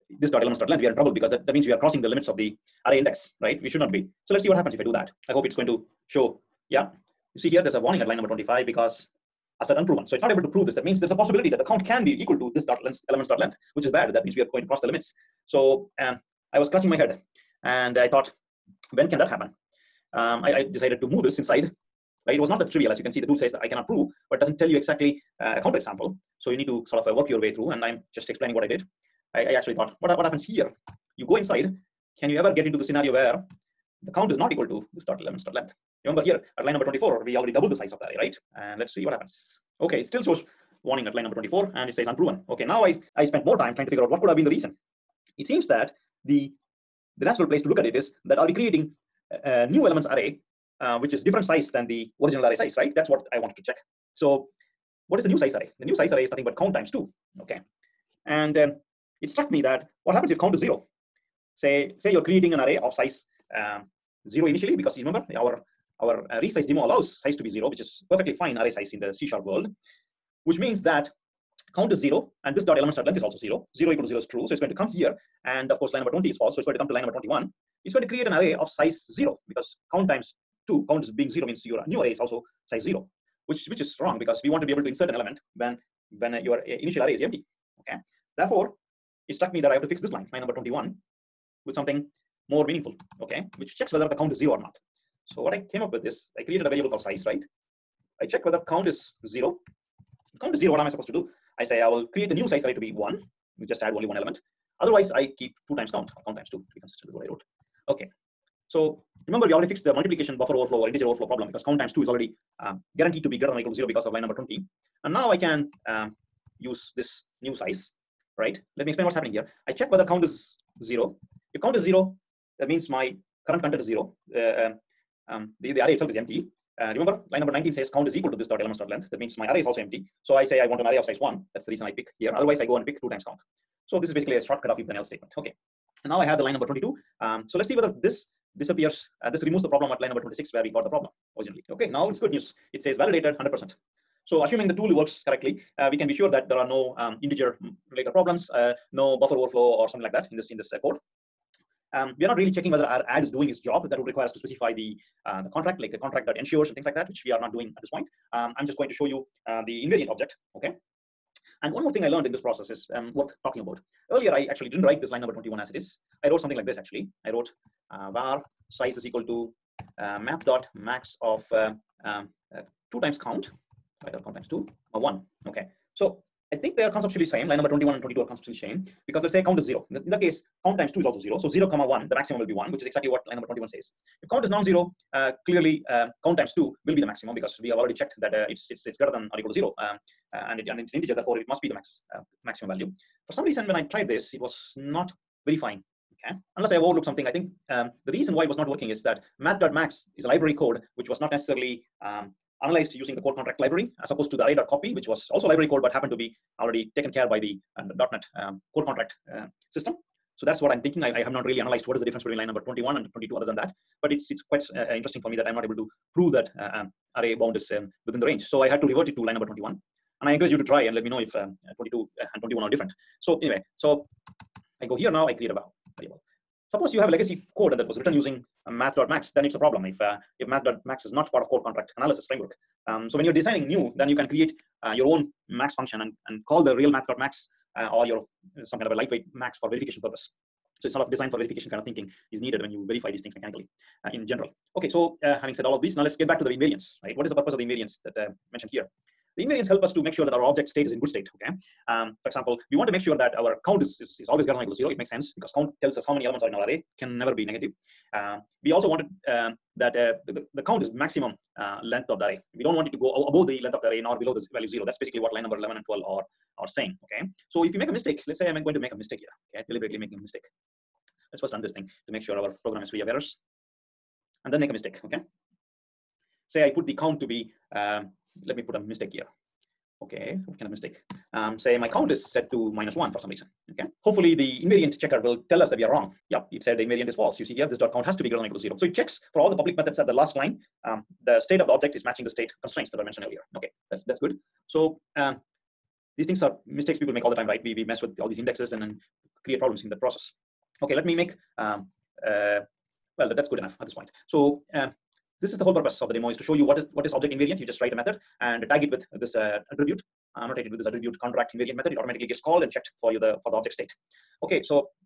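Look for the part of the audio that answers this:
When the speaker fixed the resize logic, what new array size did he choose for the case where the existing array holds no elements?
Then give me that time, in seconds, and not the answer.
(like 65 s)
101 s.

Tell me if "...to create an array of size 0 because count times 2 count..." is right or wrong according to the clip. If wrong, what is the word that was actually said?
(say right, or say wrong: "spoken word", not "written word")
right.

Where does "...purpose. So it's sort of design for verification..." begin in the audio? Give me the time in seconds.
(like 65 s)
240 s.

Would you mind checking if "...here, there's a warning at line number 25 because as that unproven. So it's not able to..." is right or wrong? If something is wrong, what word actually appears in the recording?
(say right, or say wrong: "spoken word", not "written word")
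right.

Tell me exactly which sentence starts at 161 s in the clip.
And one more thing I learned in this process is um, worth talking about.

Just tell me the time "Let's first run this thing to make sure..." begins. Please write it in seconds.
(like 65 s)
271 s.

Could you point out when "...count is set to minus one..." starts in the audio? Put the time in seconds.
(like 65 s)
281 s.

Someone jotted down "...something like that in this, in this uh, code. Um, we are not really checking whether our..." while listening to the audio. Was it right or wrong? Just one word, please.
right.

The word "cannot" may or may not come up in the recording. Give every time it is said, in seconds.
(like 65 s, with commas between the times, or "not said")
23 s.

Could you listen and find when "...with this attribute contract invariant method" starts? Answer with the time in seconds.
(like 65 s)
310 s.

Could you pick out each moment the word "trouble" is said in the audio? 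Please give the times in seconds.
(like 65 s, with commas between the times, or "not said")
0 s.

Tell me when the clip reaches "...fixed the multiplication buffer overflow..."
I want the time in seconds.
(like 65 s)
109 s.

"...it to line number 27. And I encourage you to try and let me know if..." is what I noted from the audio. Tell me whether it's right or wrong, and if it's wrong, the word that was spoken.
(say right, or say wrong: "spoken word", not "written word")
wrong: "21", not "27".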